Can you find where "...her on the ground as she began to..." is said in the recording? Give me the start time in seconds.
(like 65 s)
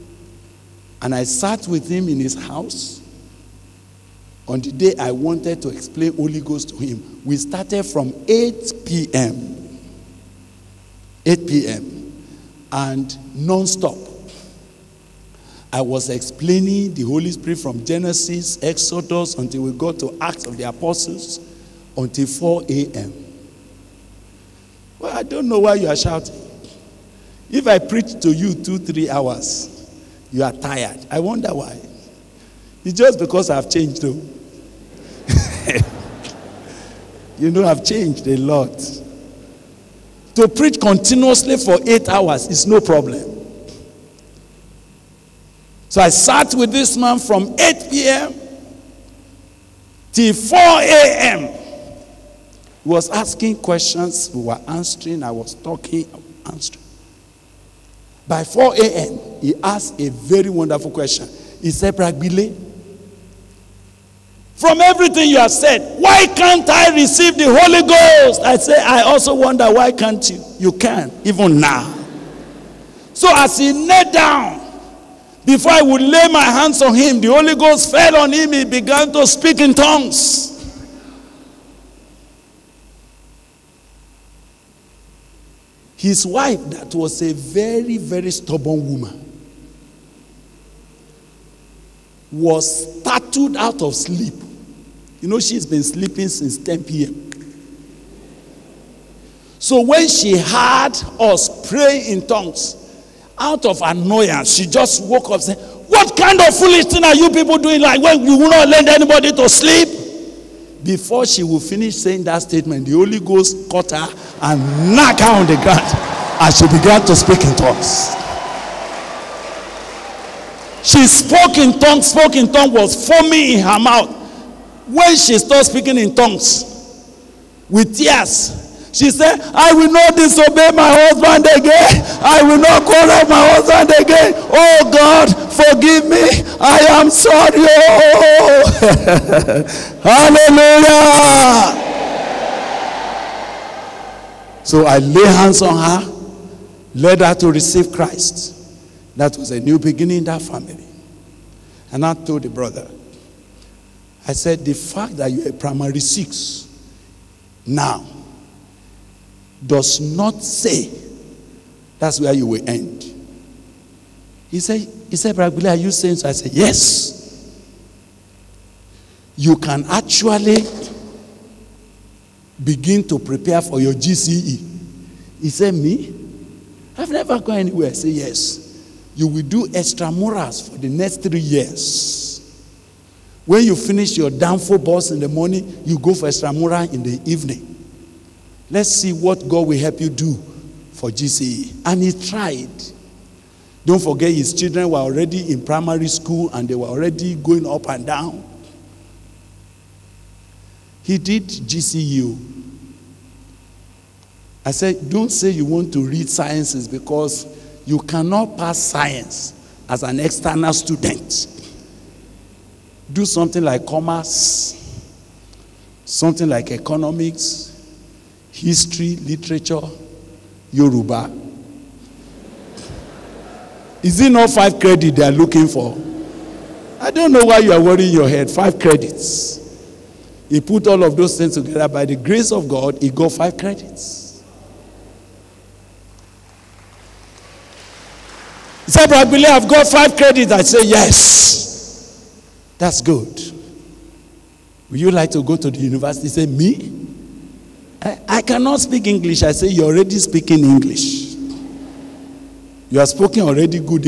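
115 s.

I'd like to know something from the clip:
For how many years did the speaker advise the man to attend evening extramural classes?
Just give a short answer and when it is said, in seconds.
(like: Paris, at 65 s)
3, at 181 s.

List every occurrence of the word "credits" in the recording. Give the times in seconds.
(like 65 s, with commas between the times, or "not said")
224 s, 228 s, 233 s, 240 s.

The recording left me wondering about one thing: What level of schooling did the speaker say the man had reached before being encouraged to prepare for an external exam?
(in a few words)
Primary six.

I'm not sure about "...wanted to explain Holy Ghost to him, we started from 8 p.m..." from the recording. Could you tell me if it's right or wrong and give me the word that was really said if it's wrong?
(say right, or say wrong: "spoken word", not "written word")
right.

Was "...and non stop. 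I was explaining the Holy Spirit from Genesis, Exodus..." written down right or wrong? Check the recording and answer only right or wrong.
right.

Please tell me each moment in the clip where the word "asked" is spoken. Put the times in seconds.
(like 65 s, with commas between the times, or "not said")
59 s.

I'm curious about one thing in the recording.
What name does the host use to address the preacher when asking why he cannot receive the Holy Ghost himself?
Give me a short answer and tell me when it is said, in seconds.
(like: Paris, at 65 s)
Bro Gbile, at 61 s.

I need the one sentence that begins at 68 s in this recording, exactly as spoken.
I say, I also wonder why can't you?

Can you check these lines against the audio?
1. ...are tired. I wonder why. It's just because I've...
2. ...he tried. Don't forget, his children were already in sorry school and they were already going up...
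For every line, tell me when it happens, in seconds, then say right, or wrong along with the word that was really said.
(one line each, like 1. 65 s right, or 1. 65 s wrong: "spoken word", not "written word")
1. 30 s right
2. 192 s wrong: "primary", not "sorry".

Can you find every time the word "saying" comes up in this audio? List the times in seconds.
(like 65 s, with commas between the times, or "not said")
105 s, 111 s, 165 s.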